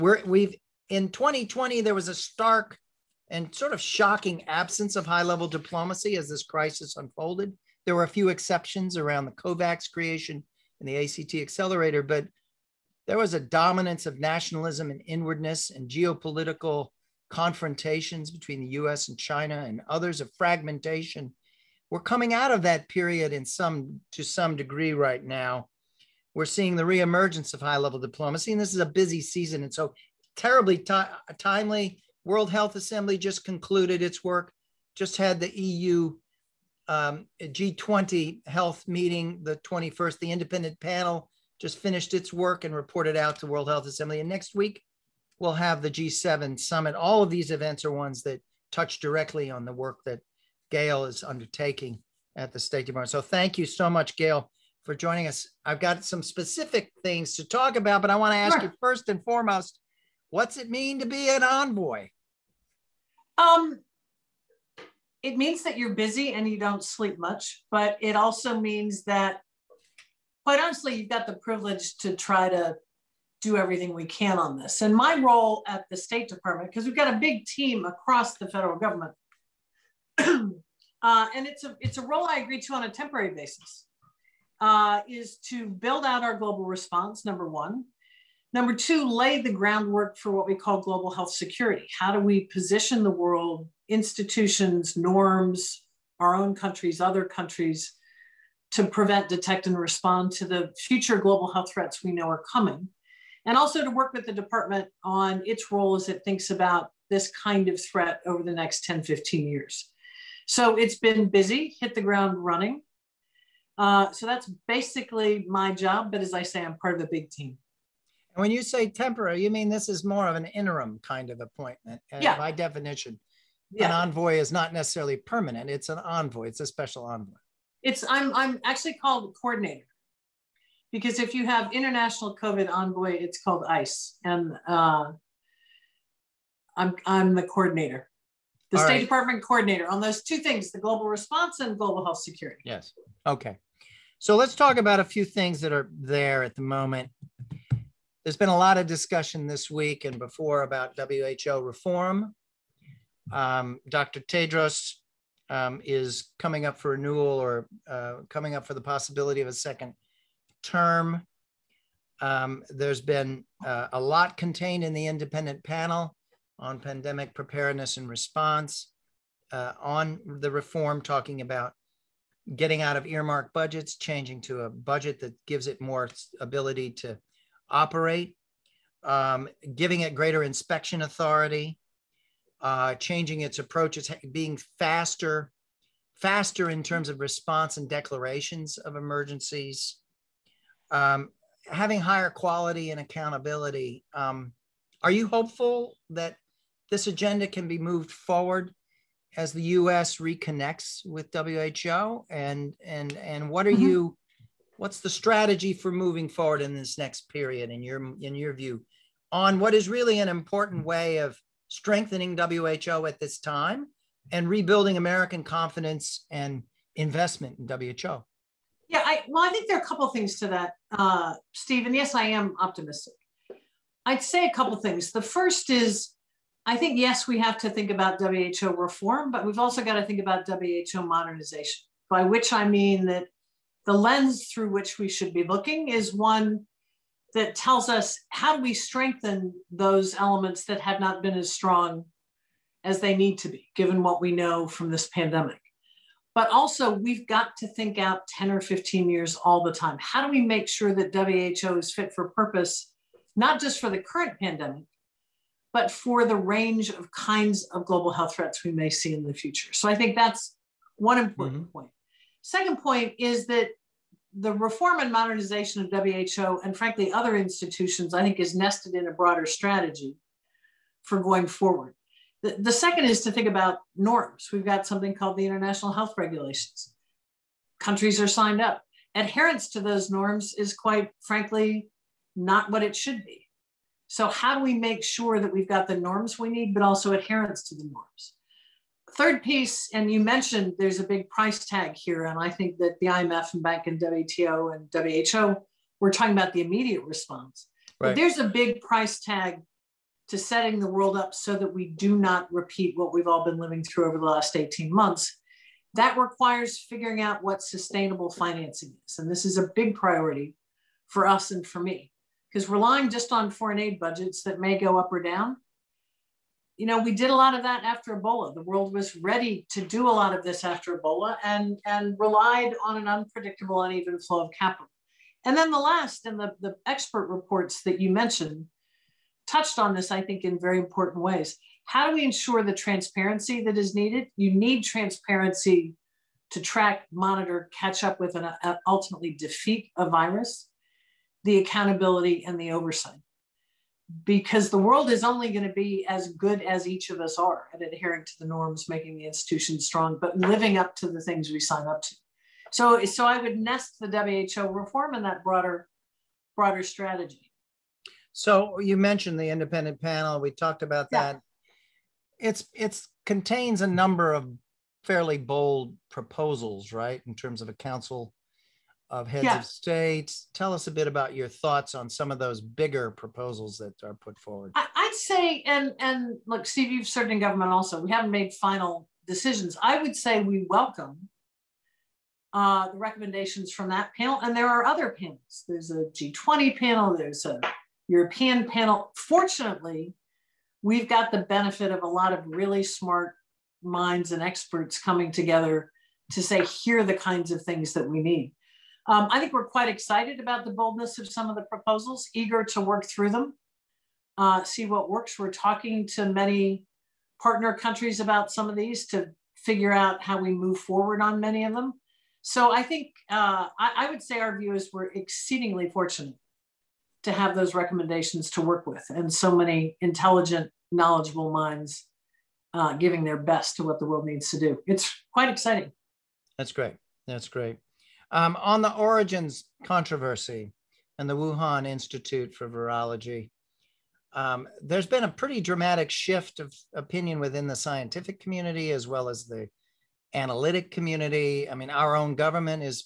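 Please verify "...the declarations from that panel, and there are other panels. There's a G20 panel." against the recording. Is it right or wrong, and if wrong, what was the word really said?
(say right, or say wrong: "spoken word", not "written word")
wrong: "recommendations", not "declarations".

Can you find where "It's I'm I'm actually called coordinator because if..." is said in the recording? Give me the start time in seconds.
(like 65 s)
127 s.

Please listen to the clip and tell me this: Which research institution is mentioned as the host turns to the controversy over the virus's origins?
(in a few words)
Wuhan Institute for Virology.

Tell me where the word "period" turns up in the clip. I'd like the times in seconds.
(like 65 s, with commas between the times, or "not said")
22 s, 207 s.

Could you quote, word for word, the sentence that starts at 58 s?
you first and foremost, what's it mean to be an envoy?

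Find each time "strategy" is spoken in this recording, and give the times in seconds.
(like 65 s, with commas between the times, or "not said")
205 s, 269 s, 356 s.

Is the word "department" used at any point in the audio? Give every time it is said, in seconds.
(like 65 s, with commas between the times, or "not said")
52 s, 76 s, 104 s, 139 s.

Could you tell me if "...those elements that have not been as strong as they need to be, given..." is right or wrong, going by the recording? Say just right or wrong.
right.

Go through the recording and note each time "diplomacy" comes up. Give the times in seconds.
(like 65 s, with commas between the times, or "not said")
5 s, 27 s.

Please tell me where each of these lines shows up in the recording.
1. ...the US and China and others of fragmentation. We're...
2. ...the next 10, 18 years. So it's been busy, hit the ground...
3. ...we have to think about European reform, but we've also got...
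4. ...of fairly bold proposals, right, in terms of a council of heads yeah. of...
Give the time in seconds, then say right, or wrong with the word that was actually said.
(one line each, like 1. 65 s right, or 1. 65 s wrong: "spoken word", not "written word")
1. 18 s right
2. 108 s wrong: "15", not "18"
3. 227 s wrong: "WHO", not "European"
4. 364 s right.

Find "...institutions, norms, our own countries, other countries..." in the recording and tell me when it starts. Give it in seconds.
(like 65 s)
93 s.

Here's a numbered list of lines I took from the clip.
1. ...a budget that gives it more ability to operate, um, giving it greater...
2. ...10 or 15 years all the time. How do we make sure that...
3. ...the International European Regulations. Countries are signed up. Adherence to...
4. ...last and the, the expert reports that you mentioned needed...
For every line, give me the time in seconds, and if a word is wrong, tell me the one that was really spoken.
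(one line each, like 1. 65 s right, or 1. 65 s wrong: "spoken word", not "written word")
1. 174 s right
2. 248 s right
3. 275 s wrong: "Health", not "European"
4. 325 s wrong: "touched", not "needed".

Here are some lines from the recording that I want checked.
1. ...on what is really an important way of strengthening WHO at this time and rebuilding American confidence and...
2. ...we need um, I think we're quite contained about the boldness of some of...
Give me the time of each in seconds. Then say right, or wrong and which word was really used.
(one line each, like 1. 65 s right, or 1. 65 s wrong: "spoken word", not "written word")
1. 209 s right
2. 398 s wrong: "excited", not "contained".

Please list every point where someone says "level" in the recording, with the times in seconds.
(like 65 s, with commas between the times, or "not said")
5 s, 27 s.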